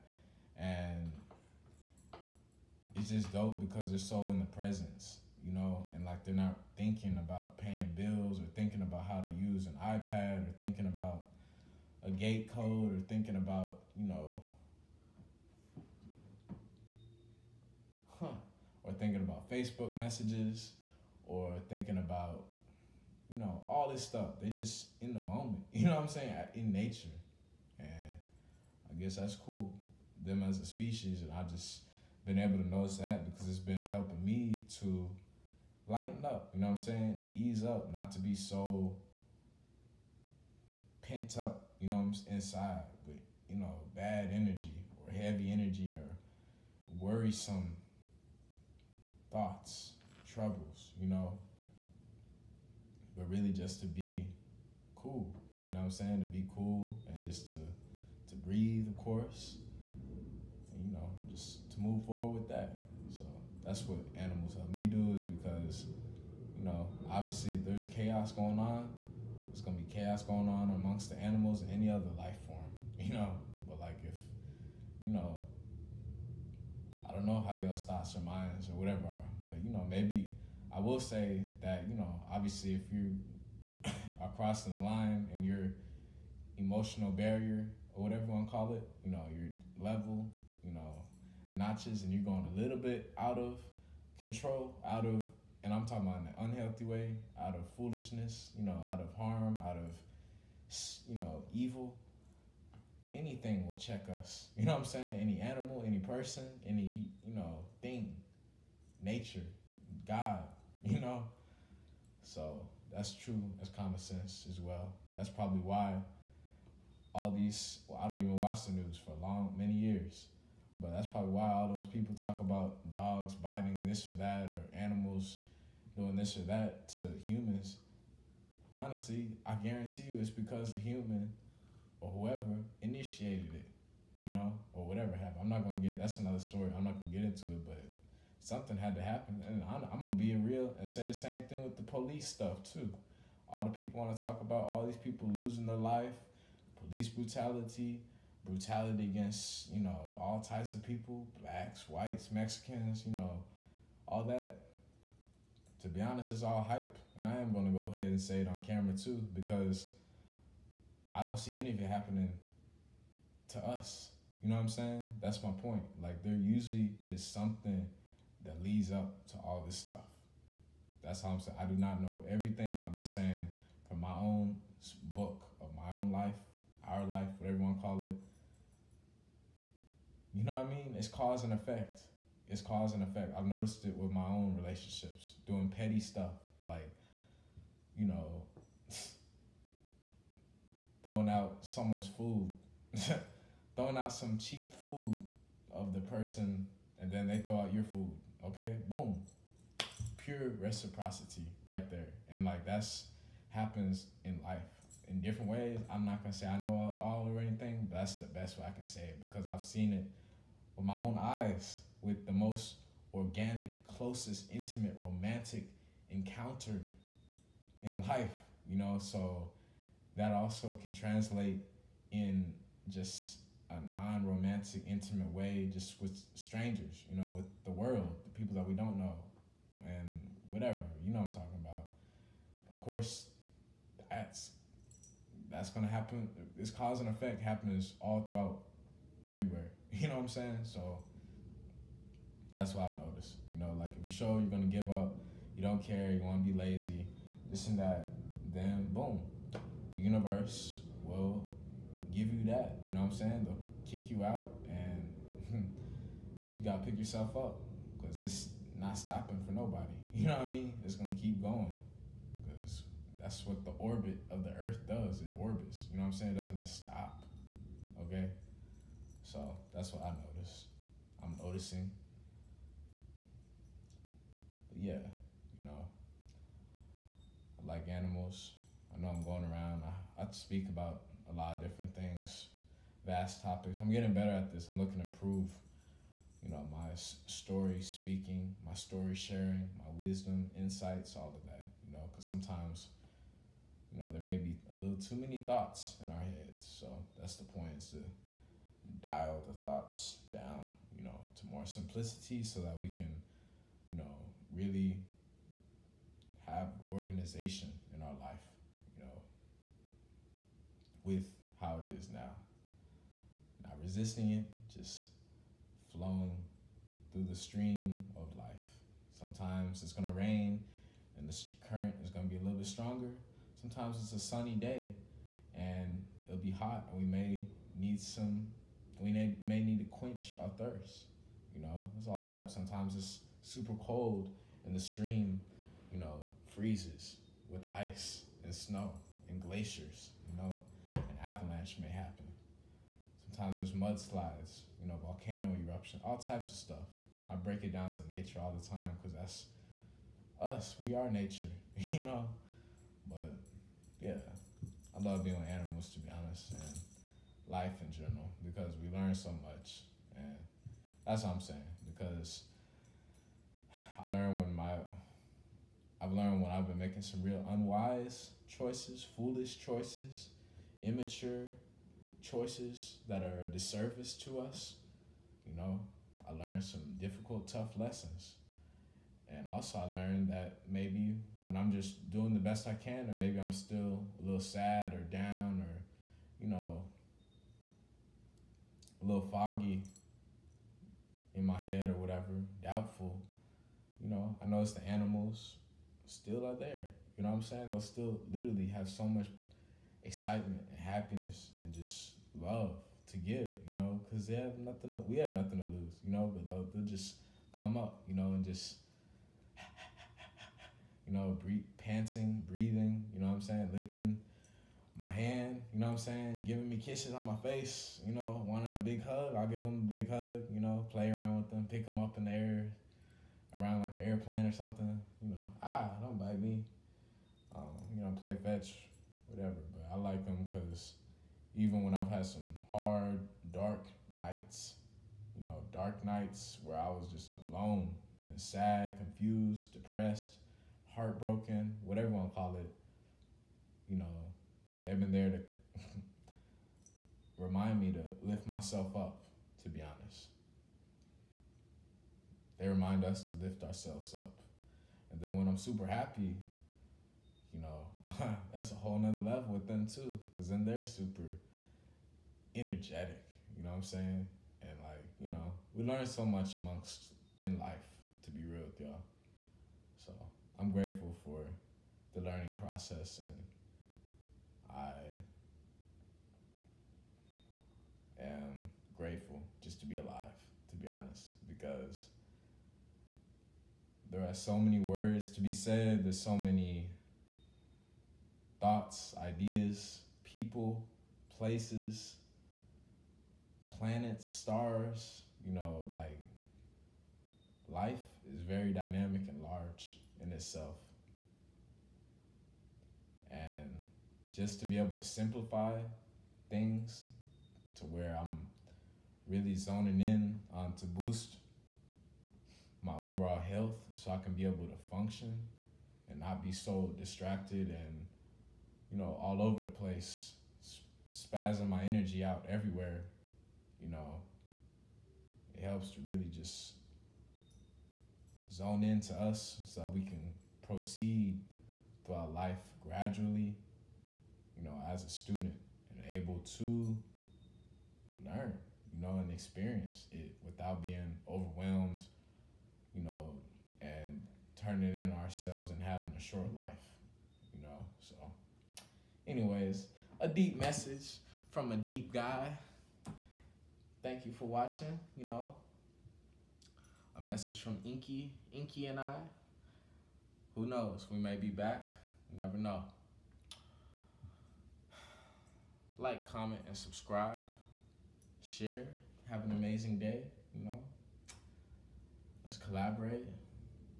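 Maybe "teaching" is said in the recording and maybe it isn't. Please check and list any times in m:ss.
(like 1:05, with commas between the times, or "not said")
not said.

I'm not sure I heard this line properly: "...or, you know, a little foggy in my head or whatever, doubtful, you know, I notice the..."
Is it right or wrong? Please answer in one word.
right.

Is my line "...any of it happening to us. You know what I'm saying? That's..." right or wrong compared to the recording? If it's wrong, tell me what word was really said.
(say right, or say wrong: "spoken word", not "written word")
right.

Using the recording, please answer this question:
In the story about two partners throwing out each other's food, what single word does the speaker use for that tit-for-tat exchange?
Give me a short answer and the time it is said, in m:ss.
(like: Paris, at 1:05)
Reciprocity, at 3:20.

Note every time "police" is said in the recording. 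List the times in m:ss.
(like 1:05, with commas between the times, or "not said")
2:21, 2:26.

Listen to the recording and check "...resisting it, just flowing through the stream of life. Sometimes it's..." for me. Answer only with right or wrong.
right.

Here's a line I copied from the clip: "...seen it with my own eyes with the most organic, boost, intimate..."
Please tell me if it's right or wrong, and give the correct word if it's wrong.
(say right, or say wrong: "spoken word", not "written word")
wrong: "closest", not "boost".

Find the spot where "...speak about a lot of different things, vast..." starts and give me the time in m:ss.
4:40.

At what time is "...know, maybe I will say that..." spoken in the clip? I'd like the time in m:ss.
1:19.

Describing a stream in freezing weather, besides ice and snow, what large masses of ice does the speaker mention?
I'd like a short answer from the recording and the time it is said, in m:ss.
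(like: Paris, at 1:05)
Glaciers, at 5:39.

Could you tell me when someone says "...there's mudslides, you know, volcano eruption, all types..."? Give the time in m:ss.
5:43.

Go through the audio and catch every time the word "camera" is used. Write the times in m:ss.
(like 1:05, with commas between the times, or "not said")
2:38.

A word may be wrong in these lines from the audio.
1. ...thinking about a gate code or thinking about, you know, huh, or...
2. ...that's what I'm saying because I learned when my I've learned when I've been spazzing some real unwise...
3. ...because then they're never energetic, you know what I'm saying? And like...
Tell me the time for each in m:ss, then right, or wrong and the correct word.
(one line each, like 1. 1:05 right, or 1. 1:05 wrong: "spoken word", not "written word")
1. 0:10 right
2. 6:01 wrong: "making", not "spazzing"
3. 7:40 wrong: "super", not "never".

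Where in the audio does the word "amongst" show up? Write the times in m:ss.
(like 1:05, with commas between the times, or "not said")
1:10, 7:46.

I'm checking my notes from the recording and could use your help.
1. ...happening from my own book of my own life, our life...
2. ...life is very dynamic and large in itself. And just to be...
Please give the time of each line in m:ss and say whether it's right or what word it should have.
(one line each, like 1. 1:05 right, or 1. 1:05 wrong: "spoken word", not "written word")
1. 2:53 wrong: "saying", not "happening"
2. 8:17 right.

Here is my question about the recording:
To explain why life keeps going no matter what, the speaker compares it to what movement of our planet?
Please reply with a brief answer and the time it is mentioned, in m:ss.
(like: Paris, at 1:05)
The orbit of the Earth, at 4:23.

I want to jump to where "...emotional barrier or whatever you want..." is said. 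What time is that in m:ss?
1:26.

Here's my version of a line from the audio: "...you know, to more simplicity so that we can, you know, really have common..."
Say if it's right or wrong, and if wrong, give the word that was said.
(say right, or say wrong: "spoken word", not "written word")
wrong: "organization", not "common".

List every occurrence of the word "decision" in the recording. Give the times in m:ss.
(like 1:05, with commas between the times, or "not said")
not said.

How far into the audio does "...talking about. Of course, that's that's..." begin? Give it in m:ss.
3:51.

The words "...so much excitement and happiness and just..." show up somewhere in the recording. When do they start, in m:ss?
6:38.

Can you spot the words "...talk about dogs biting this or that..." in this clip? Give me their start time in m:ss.
2:02.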